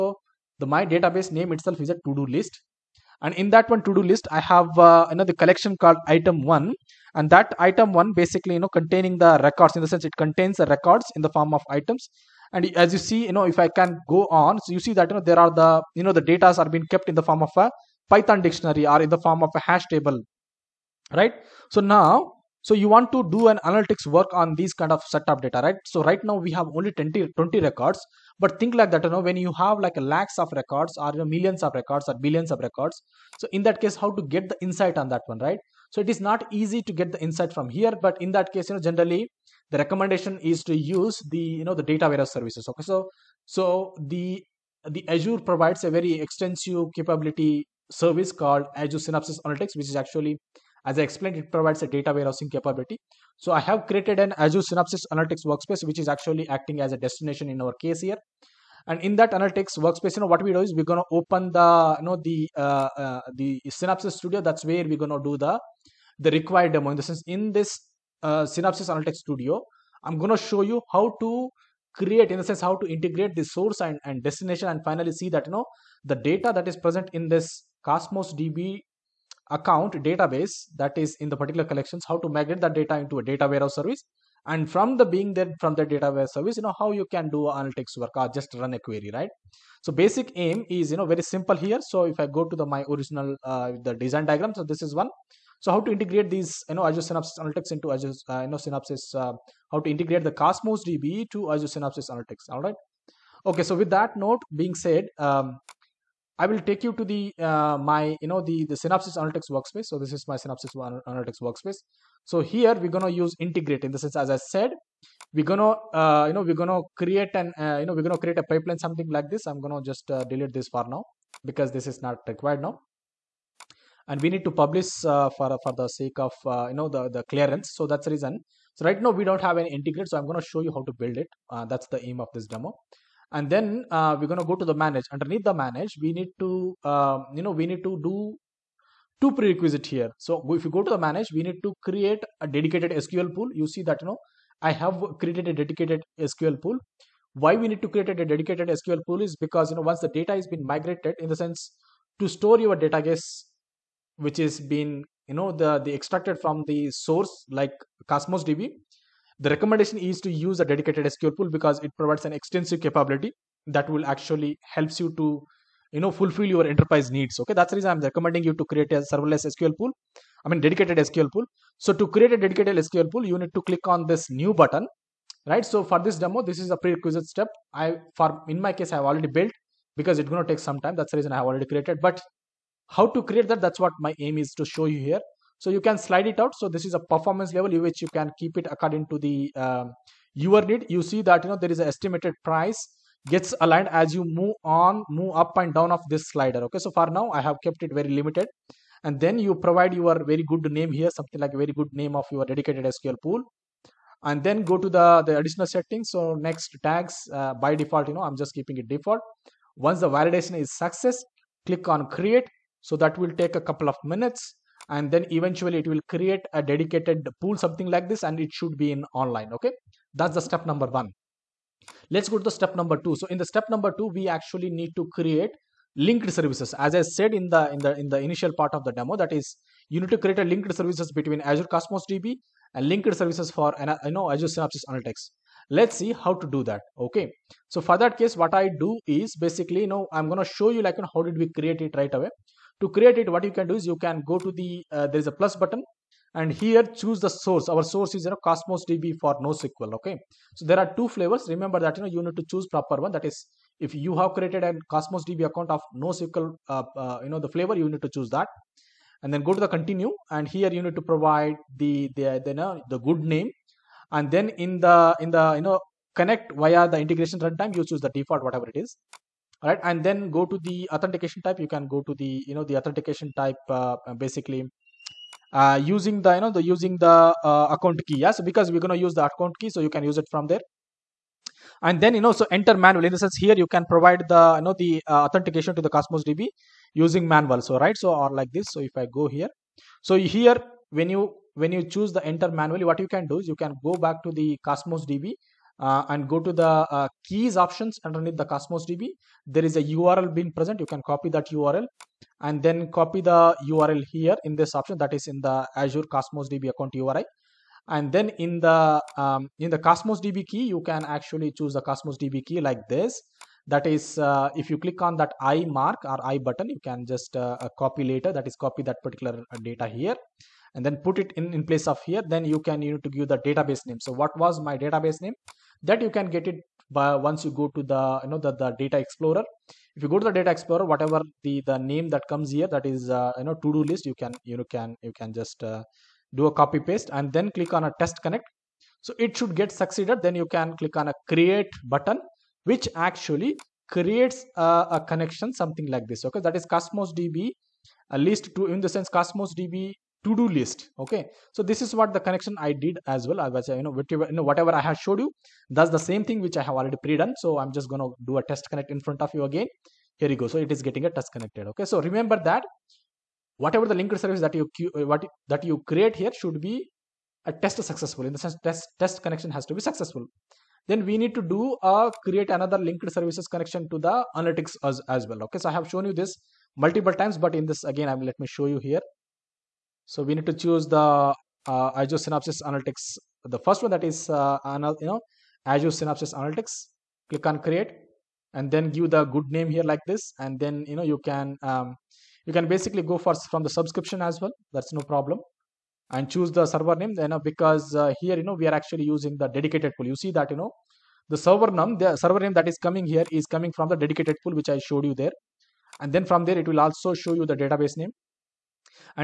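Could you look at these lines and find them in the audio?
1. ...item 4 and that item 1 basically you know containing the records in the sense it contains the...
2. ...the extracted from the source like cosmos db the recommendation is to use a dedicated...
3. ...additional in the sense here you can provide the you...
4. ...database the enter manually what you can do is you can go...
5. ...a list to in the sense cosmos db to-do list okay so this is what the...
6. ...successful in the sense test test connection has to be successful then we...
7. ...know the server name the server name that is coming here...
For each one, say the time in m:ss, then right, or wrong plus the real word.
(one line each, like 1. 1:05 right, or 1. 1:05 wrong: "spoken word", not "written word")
1. 0:06 wrong: "1", not "4"
2. 2:35 right
3. 4:42 wrong: "manual", not "additional"
4. 4:51 wrong: "choose", not "database"
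5. 5:48 right
6. 6:07 right
7. 6:40 right.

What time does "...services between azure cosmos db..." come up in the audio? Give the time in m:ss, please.
3:50.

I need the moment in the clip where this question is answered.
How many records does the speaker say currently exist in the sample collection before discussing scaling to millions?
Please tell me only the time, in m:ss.
0:27.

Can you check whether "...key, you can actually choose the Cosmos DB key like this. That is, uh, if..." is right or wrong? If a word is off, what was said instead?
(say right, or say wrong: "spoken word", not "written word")
right.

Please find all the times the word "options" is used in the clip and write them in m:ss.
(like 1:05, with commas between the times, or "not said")
4:57, 5:04.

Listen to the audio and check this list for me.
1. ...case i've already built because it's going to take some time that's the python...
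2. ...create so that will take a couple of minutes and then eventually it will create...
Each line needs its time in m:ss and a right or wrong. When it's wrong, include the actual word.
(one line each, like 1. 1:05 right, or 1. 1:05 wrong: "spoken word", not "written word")
1. 2:58 wrong: "reason", not "python"
2. 3:32 right.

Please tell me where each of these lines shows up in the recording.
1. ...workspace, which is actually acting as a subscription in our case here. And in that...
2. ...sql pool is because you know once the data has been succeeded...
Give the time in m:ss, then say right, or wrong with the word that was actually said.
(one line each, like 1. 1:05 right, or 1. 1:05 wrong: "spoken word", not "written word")
1. 0:55 wrong: "destination", not "subscription"
2. 2:28 wrong: "migrated", not "succeeded".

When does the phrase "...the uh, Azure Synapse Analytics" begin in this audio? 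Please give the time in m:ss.
6:20.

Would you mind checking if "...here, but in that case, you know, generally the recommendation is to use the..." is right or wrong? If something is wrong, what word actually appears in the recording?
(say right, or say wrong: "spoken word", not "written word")
right.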